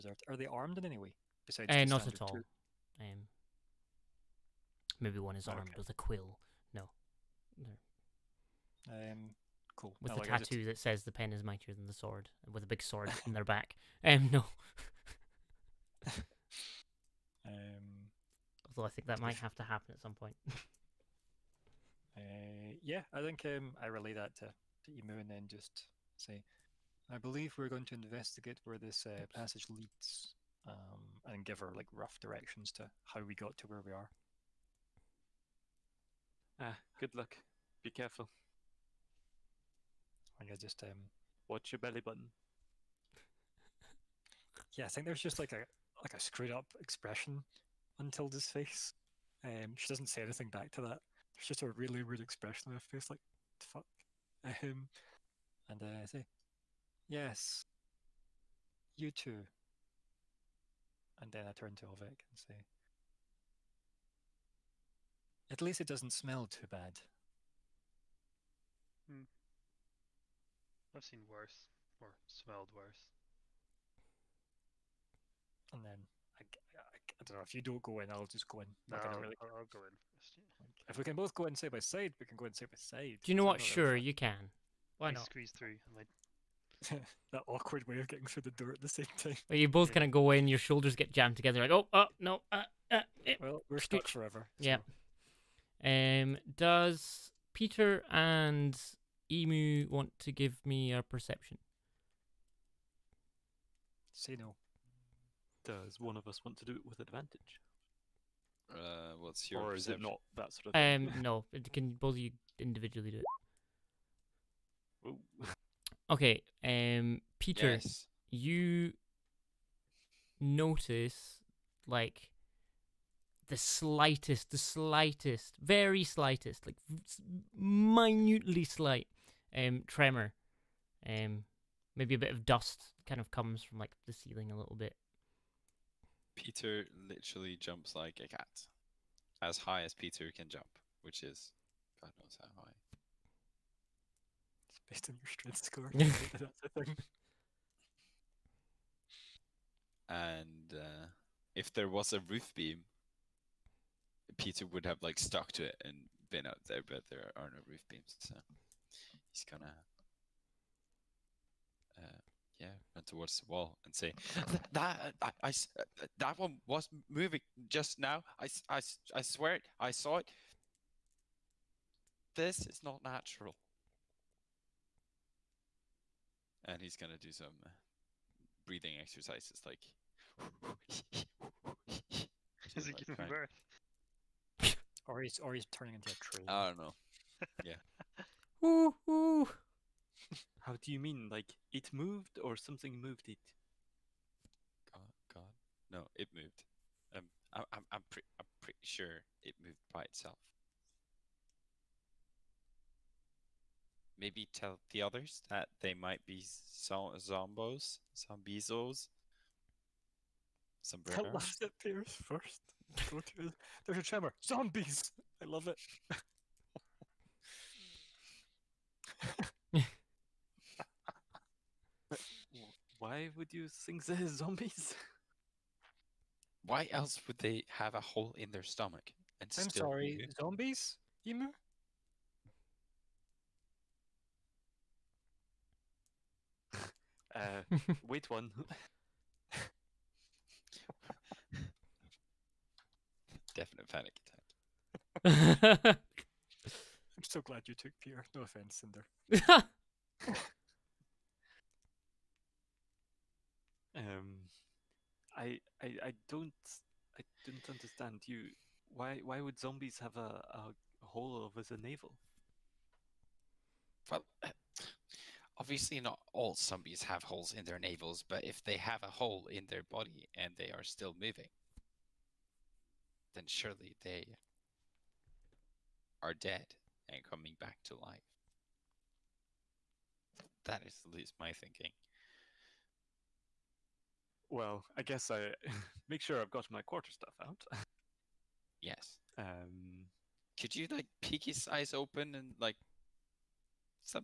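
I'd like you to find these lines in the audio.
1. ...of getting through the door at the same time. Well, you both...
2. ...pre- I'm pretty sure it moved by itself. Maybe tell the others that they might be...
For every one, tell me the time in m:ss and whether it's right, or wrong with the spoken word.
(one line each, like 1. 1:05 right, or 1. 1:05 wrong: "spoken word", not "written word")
1. 1:27 right
2. 3:18 right.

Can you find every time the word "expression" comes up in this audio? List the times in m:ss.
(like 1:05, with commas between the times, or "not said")
0:46, 0:52.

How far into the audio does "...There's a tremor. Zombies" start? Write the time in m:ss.
3:33.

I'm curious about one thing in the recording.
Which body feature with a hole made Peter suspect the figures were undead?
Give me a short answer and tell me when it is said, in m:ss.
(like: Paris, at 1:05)
The navel, at 4:21.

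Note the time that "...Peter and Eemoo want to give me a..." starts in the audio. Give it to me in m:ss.
1:37.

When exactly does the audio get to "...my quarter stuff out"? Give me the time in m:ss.
4:46.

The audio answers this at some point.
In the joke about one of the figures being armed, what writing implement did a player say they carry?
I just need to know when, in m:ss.
0:05.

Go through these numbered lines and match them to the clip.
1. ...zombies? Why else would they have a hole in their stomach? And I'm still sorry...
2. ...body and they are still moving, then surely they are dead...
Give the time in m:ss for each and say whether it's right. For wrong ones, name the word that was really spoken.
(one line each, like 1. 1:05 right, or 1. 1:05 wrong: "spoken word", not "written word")
1. 3:44 right
2. 4:29 right.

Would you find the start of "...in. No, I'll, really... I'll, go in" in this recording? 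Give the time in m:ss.
1:18.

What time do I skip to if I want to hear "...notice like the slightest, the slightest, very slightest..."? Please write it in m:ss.
2:00.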